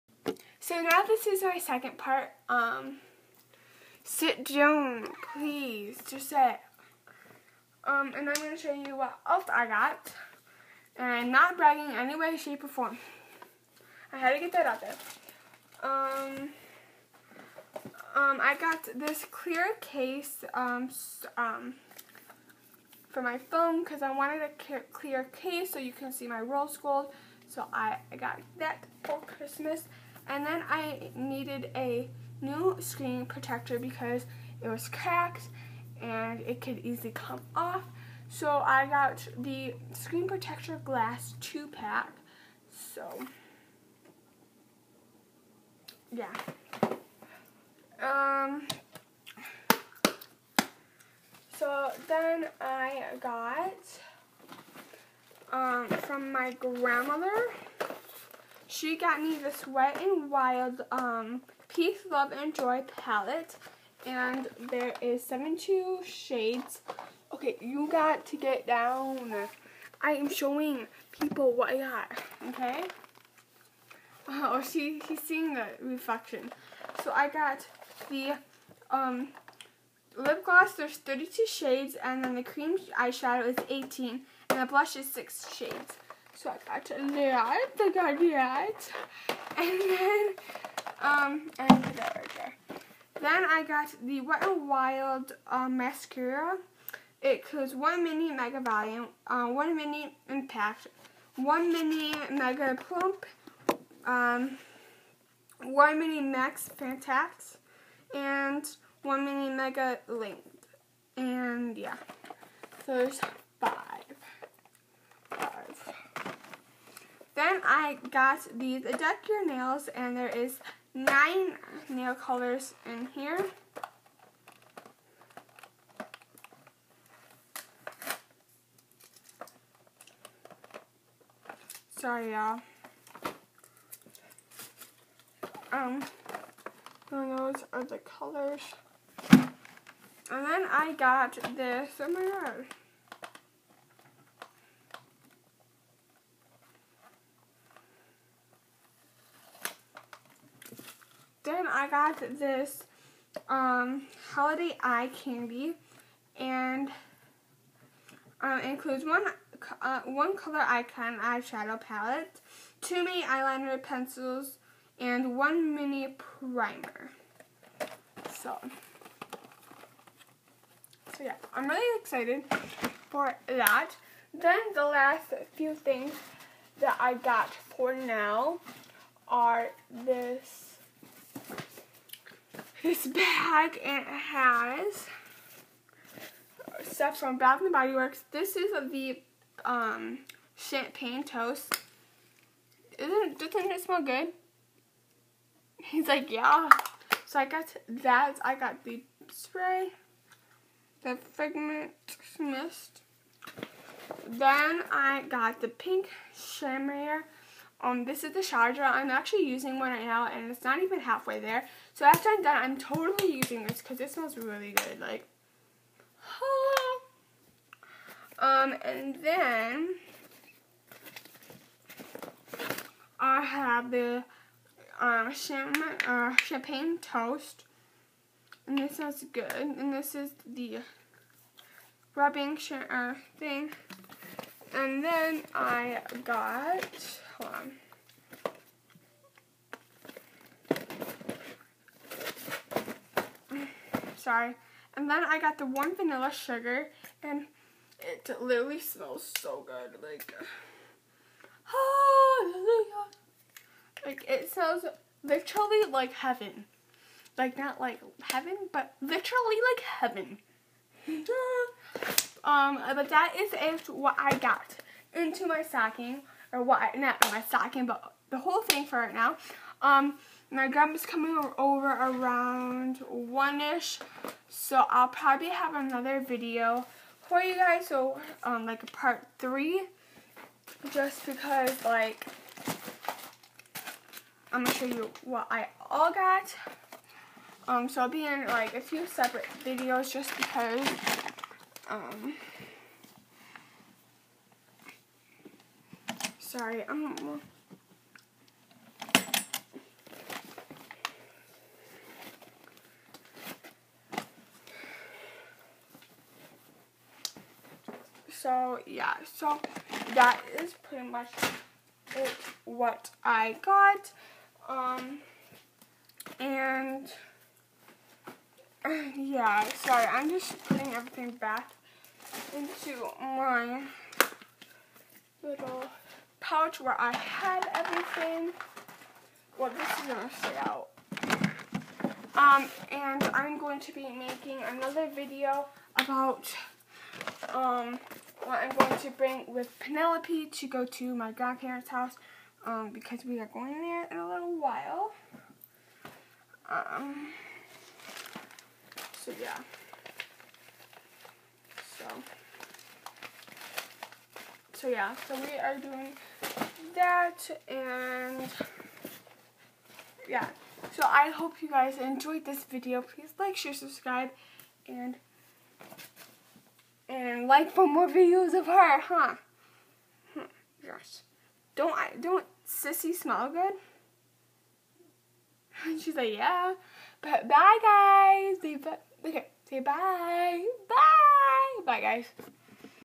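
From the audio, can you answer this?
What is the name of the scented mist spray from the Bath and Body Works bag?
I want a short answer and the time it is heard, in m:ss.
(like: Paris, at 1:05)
Figment mist, at 3:21.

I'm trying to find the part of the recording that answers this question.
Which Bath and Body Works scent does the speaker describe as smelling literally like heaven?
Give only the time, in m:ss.
4:05.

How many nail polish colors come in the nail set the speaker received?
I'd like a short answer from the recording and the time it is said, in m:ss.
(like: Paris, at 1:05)
9, at 2:00.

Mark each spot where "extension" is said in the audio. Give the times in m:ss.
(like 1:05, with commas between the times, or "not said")
not said.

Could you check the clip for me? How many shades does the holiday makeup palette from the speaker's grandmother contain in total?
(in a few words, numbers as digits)
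72.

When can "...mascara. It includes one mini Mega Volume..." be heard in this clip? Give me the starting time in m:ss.
1:35.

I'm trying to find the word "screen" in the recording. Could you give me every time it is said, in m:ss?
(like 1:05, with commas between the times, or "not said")
0:32, 0:39.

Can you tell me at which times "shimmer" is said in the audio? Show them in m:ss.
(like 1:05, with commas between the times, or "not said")
3:26.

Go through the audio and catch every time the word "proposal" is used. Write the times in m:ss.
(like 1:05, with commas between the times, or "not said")
not said.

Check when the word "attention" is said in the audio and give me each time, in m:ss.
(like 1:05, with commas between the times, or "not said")
not said.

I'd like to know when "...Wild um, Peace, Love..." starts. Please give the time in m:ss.
1:00.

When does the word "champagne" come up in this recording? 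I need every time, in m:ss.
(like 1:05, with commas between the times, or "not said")
3:10, 3:46.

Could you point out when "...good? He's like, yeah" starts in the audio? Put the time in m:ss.
3:14.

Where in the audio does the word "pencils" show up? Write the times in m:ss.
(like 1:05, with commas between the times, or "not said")
2:43.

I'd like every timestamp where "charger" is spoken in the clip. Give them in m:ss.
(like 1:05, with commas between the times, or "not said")
3:28.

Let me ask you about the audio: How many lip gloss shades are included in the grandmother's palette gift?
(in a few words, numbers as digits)
32.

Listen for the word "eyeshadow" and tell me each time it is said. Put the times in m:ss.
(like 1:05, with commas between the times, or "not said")
1:22, 2:41.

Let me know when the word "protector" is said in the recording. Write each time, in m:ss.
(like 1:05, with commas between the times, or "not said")
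0:33, 0:40.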